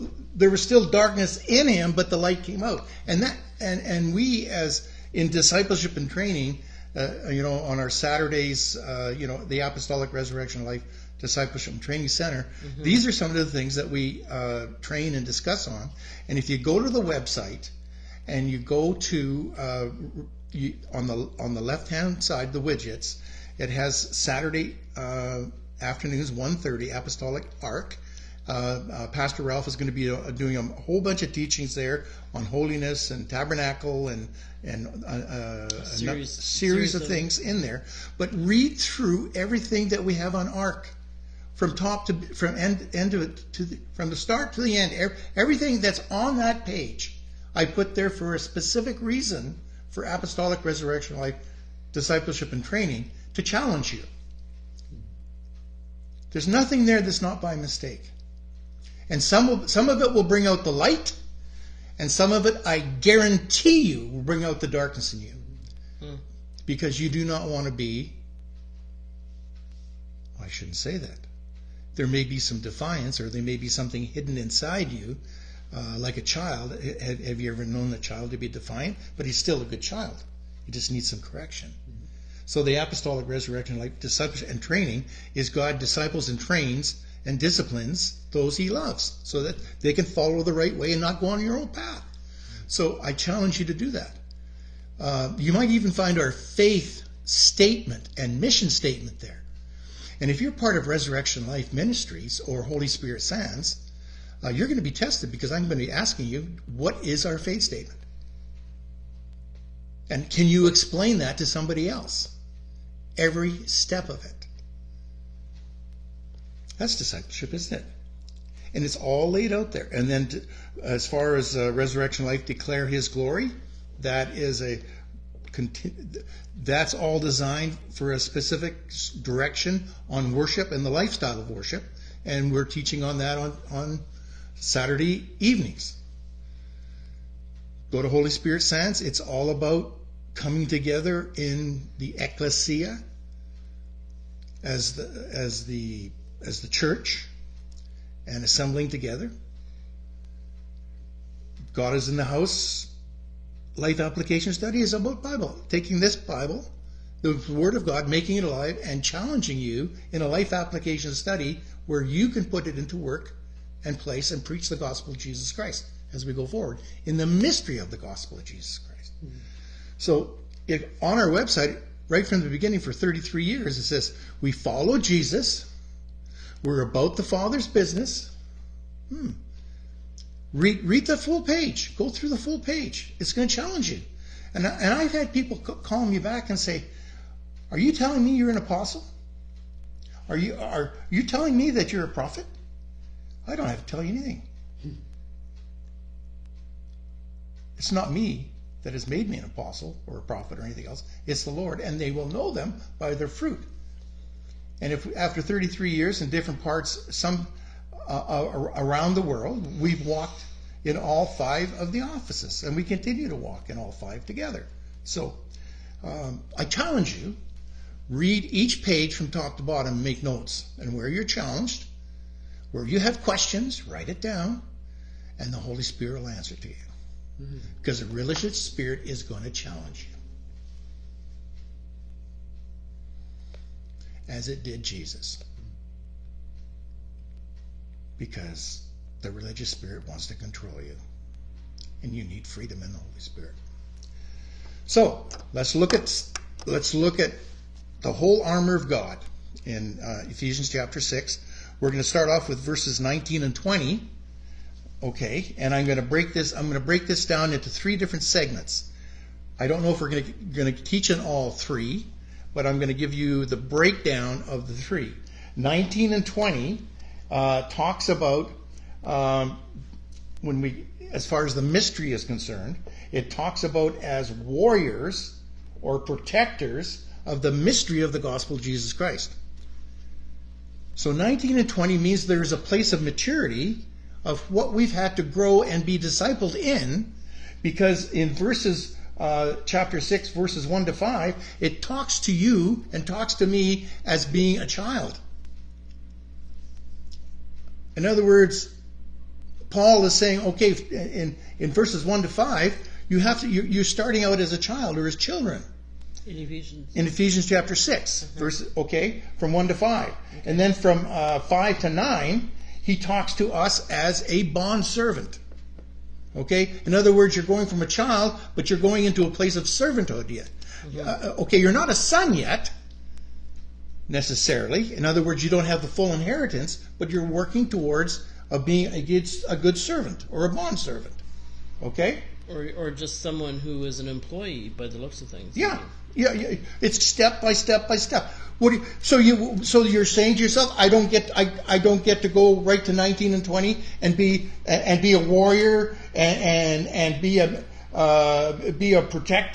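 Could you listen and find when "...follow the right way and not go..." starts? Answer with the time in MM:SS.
01:30.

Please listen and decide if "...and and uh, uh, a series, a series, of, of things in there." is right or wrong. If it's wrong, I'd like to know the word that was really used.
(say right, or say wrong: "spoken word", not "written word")
right.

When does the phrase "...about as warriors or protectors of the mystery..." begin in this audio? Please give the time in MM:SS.
04:33.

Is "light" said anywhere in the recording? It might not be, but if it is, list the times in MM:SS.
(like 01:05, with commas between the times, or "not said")
00:02, 01:00.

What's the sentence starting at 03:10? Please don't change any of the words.
Are you, are you telling me that you're a prophet?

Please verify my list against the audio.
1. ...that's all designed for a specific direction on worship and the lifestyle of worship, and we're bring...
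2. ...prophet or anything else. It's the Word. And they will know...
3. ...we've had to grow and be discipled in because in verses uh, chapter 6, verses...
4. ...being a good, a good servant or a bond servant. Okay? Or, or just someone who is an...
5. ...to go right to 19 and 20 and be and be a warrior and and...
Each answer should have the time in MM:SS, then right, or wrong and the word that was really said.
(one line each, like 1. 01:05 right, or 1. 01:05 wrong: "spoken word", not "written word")
1. 02:06 wrong: "teaching", not "bring"
2. 03:20 wrong: "Lord", not "Word"
3. 04:44 right
4. 05:28 right
5. 05:42 right.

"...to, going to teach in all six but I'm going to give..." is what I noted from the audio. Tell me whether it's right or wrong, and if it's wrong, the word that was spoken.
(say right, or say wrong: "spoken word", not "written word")
wrong: "three", not "six".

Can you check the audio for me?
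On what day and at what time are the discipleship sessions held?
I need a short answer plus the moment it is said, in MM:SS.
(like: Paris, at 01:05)
Saturday afternoons 1:30, at 00:24.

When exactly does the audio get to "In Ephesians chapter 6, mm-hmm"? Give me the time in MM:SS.
05:06.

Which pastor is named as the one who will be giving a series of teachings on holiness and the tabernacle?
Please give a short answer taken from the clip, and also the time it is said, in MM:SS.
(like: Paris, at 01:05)
Pastor Ralph, at 00:29.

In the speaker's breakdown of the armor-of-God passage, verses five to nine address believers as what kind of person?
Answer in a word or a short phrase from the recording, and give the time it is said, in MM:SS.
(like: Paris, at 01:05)
A bondservant, at 05:14.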